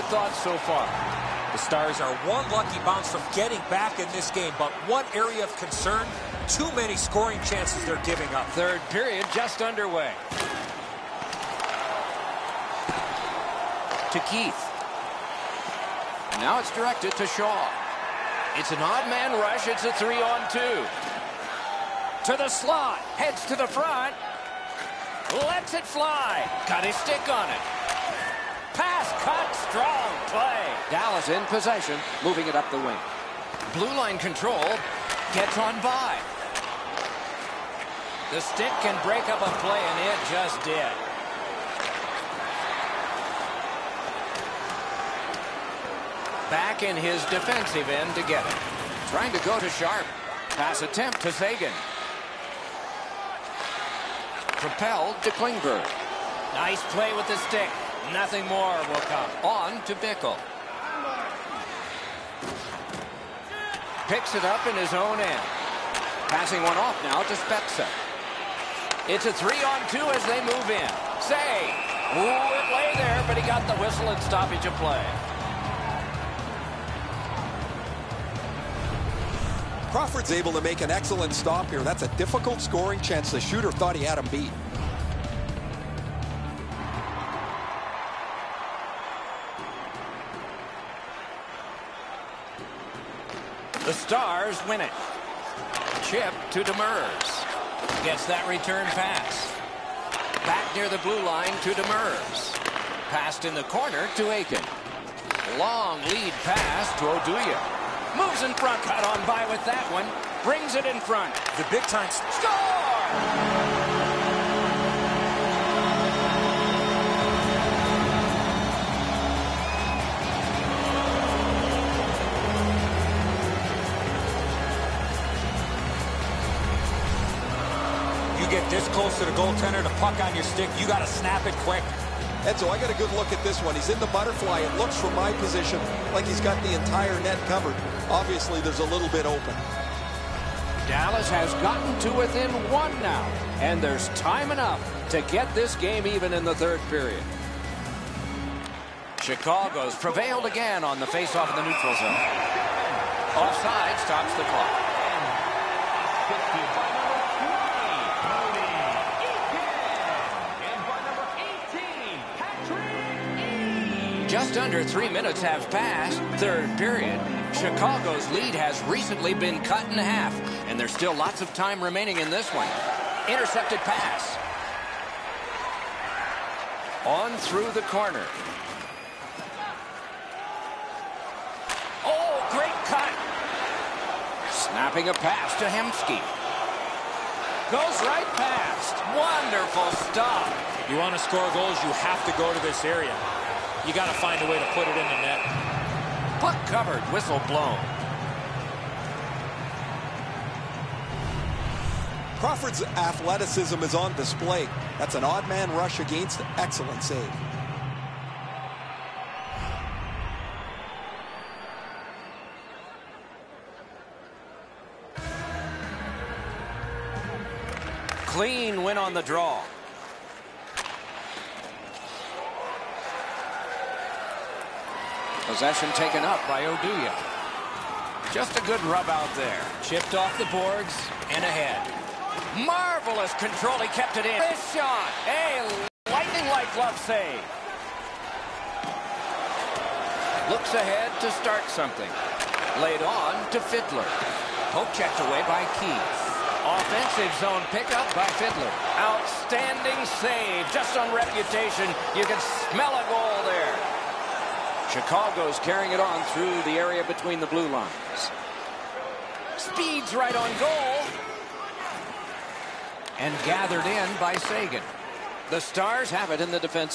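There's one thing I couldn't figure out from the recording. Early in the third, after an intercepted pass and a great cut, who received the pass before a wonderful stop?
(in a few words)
Hemsky.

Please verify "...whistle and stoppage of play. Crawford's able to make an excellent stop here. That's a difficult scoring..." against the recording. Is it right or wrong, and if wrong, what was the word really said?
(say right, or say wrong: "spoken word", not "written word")
right.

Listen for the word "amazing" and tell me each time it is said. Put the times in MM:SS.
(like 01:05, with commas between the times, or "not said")
not said.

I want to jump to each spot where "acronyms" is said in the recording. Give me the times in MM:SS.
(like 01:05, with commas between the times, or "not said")
not said.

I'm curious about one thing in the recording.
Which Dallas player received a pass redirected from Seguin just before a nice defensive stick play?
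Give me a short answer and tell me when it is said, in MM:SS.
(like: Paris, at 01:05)
Klingberg, at 00:55.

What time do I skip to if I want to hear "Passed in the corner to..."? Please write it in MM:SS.
01:43.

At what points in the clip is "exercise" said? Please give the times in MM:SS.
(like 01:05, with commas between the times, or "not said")
not said.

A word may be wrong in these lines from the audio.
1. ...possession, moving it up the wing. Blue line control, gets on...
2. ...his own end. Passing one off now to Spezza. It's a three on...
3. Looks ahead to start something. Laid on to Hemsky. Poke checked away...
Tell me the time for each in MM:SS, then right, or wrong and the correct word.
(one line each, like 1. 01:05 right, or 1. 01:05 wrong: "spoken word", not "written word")
1. 00:31 right
2. 01:04 right
3. 04:00 wrong: "Fiddler", not "Hemsky".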